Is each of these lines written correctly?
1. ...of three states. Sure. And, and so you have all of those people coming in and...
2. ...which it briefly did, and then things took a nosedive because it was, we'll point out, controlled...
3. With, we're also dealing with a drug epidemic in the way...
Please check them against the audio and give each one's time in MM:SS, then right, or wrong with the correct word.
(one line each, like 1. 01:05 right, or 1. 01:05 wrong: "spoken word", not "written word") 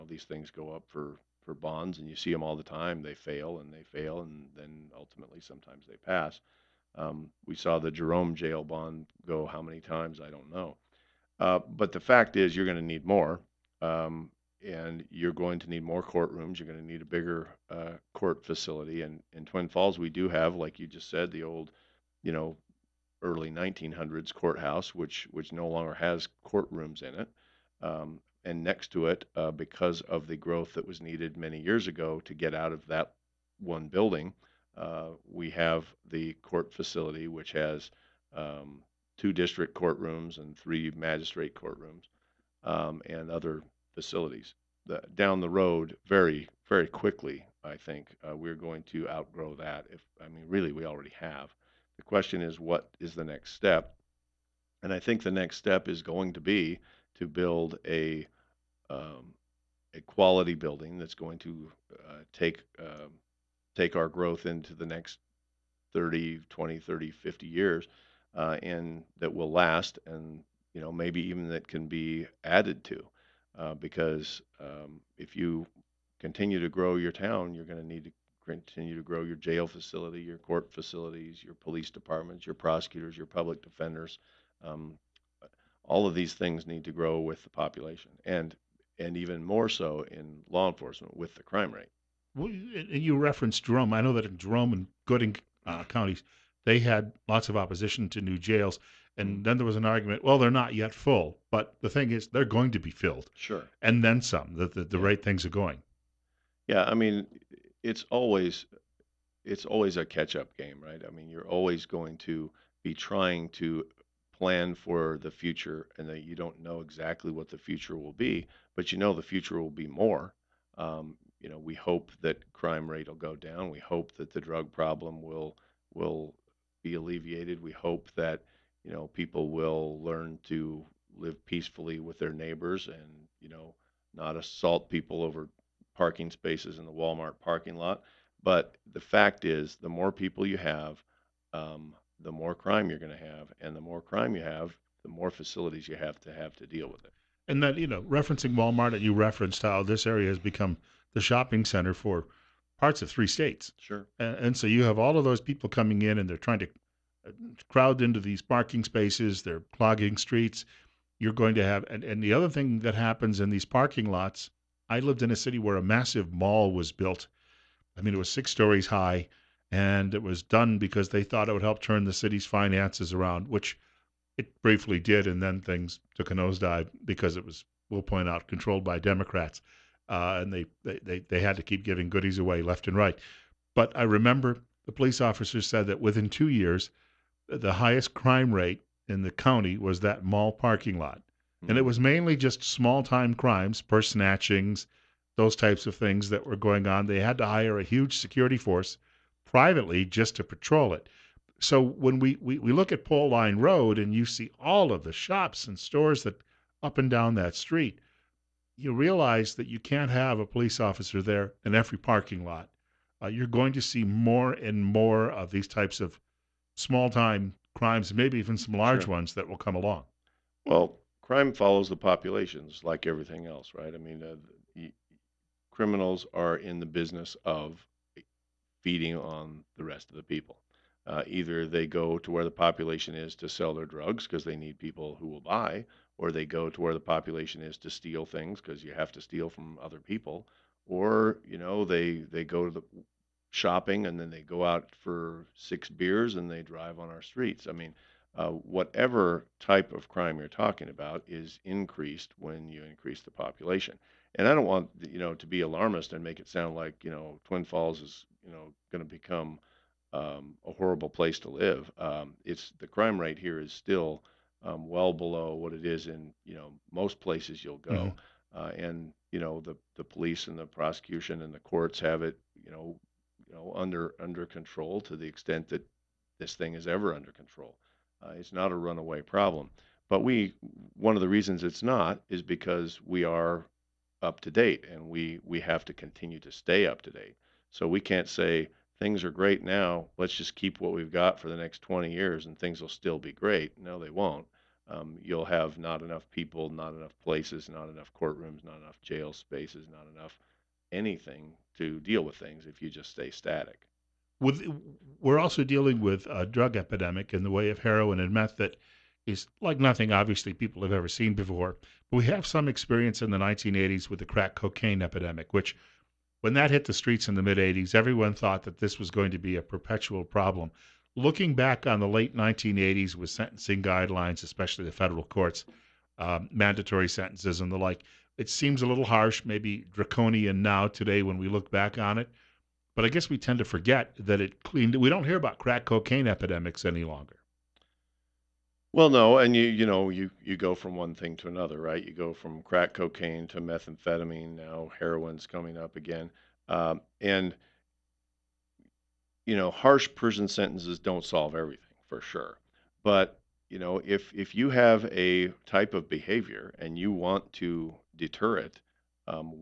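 1. 02:33 right
2. 02:53 right
3. 05:04 right.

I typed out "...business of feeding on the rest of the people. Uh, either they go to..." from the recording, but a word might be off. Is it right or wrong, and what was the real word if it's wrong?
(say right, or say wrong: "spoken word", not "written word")
right.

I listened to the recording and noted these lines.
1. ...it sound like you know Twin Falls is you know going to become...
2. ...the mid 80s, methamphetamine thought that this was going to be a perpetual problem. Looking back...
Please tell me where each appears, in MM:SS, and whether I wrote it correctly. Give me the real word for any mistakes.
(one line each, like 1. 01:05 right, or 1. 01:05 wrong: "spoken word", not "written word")
1. 04:16 right
2. 05:17 wrong: "everyone", not "methamphetamine".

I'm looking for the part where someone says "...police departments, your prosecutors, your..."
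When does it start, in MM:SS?
01:21.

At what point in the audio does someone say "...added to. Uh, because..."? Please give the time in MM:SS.
01:12.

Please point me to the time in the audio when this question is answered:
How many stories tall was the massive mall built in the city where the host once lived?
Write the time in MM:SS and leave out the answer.
02:48.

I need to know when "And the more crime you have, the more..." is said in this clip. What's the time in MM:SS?
02:23.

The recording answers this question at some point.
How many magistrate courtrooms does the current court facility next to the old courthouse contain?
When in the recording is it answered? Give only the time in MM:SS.
00:40.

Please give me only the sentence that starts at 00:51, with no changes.
The question is, what is the next step?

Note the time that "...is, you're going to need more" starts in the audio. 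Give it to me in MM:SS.
00:12.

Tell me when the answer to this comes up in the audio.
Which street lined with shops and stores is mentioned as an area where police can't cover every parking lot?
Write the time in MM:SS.
03:23.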